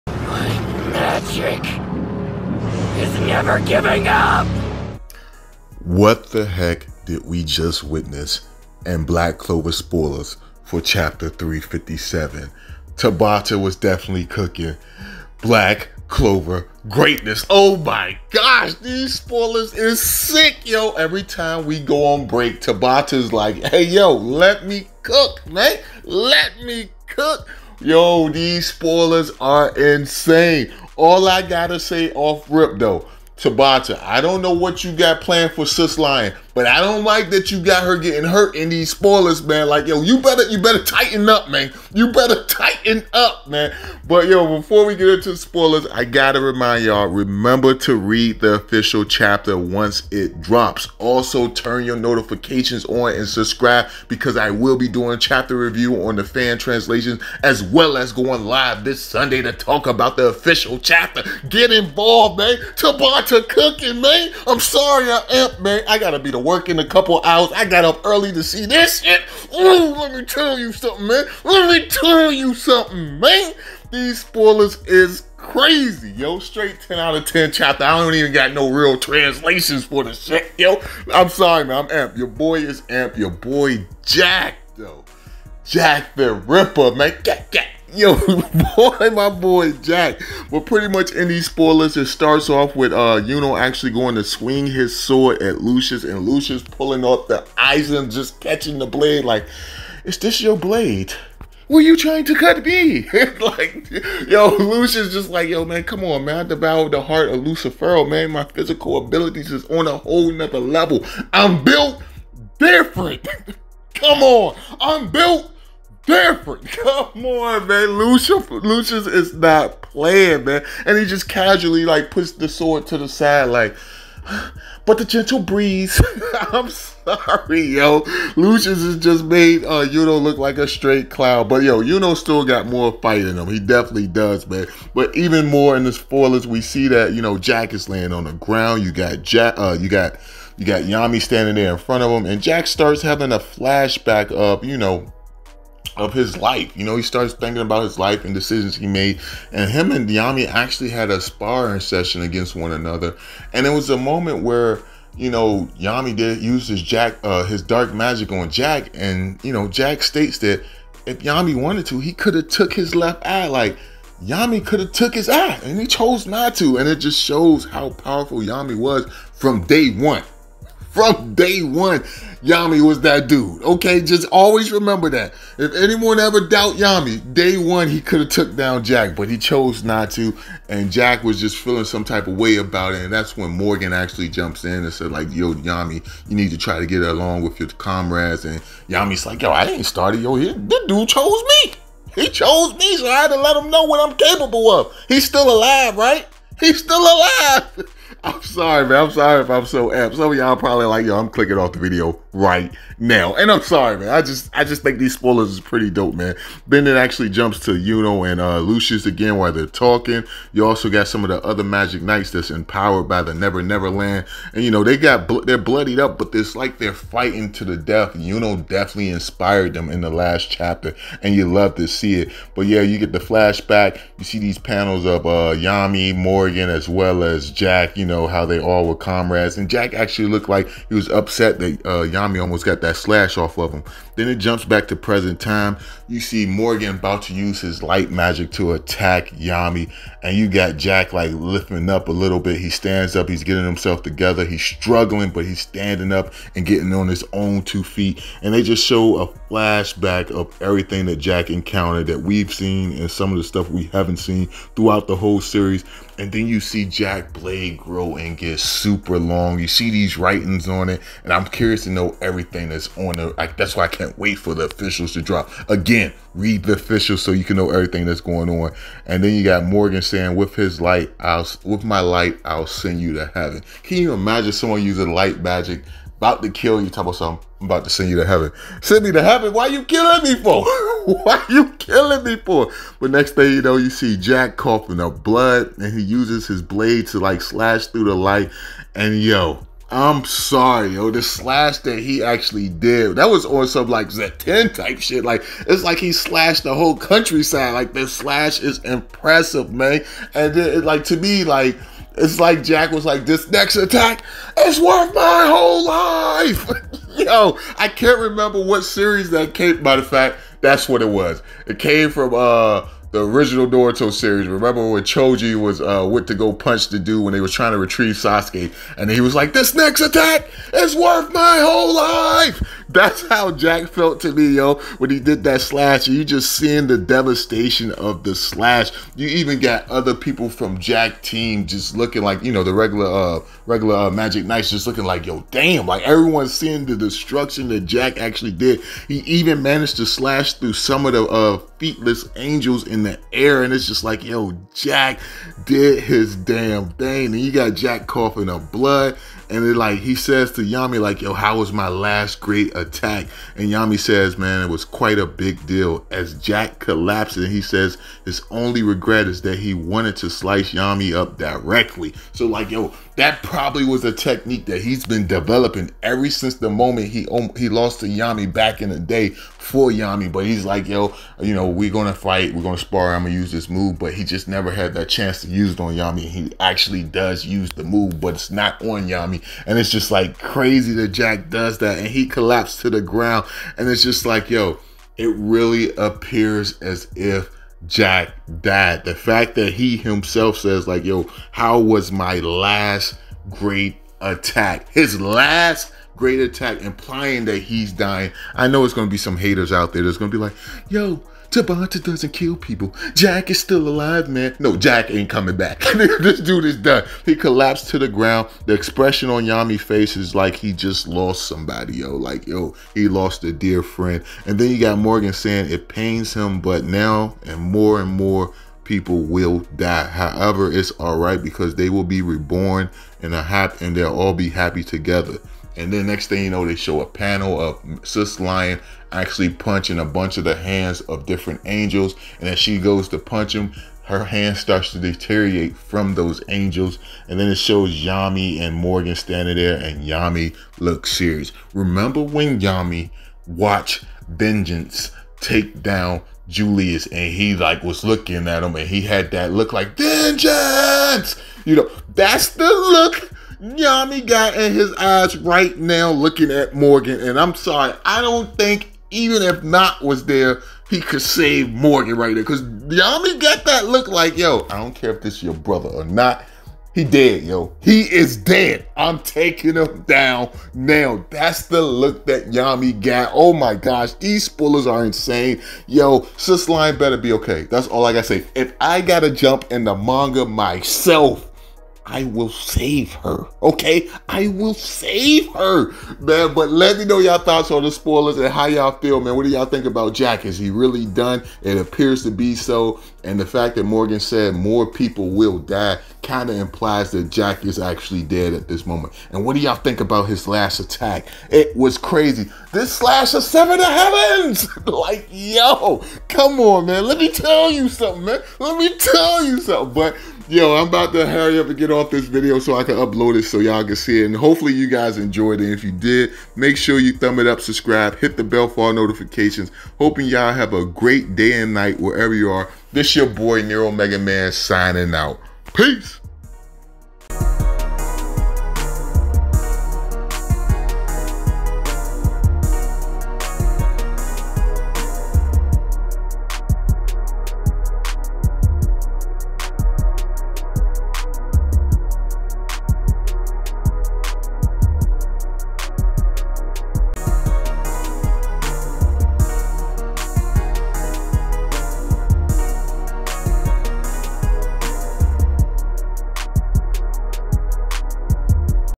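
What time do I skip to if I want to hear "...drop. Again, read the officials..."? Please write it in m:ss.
4:25.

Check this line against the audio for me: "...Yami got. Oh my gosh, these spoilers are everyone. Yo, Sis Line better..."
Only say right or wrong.
wrong.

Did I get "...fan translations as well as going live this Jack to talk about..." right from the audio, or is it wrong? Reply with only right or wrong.
wrong.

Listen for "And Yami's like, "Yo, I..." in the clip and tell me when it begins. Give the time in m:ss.
3:08.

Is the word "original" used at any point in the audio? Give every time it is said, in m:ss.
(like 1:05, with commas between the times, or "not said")
5:13.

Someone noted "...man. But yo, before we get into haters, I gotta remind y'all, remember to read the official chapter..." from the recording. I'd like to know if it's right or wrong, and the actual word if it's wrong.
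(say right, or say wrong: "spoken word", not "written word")
wrong: "spoilers", not "haters".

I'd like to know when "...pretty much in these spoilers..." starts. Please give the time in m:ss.
1:30.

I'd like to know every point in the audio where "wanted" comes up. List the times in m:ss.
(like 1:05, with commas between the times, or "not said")
2:41, 5:59.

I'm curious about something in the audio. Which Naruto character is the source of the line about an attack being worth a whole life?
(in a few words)
Choji.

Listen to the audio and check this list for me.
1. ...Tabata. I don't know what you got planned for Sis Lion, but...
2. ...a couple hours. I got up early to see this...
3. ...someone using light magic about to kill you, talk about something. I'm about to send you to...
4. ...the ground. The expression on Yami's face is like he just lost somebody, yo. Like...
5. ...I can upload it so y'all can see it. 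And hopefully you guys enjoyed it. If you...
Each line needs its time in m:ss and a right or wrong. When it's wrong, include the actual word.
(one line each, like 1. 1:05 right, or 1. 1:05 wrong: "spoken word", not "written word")
1. 0:33 right
2. 1:06 right
3. 4:34 right
4. 6:47 right
5. 8:32 right.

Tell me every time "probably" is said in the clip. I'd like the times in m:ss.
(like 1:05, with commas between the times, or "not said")
3:20, 6:03.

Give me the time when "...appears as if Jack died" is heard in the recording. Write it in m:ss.
6:25.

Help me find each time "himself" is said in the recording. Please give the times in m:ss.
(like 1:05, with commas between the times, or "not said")
4:03, 6:29.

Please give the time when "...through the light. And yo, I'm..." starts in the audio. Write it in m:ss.
4:47.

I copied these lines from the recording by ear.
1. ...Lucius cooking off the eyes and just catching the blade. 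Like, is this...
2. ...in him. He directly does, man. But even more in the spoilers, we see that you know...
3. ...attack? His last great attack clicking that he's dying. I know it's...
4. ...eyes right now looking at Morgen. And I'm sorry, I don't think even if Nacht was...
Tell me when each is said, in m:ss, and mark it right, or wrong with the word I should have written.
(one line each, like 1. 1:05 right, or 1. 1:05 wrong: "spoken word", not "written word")
1. 1:36 wrong: "pulling", not "cooking"
2. 2:13 wrong: "definitely", not "directly"
3. 6:34 wrong: "implying", not "clicking"
4. 7:34 right.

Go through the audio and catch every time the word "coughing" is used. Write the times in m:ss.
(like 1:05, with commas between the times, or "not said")
4:44, 5:48.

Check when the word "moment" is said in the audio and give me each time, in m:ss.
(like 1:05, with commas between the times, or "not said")
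2:33, 6:06, 8:18.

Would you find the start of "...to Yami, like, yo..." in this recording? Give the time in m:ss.
5:50.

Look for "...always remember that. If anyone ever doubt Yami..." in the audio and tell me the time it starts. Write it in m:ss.
2:54.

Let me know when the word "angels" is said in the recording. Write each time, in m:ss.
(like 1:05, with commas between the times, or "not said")
5:42, 7:11, 7:16.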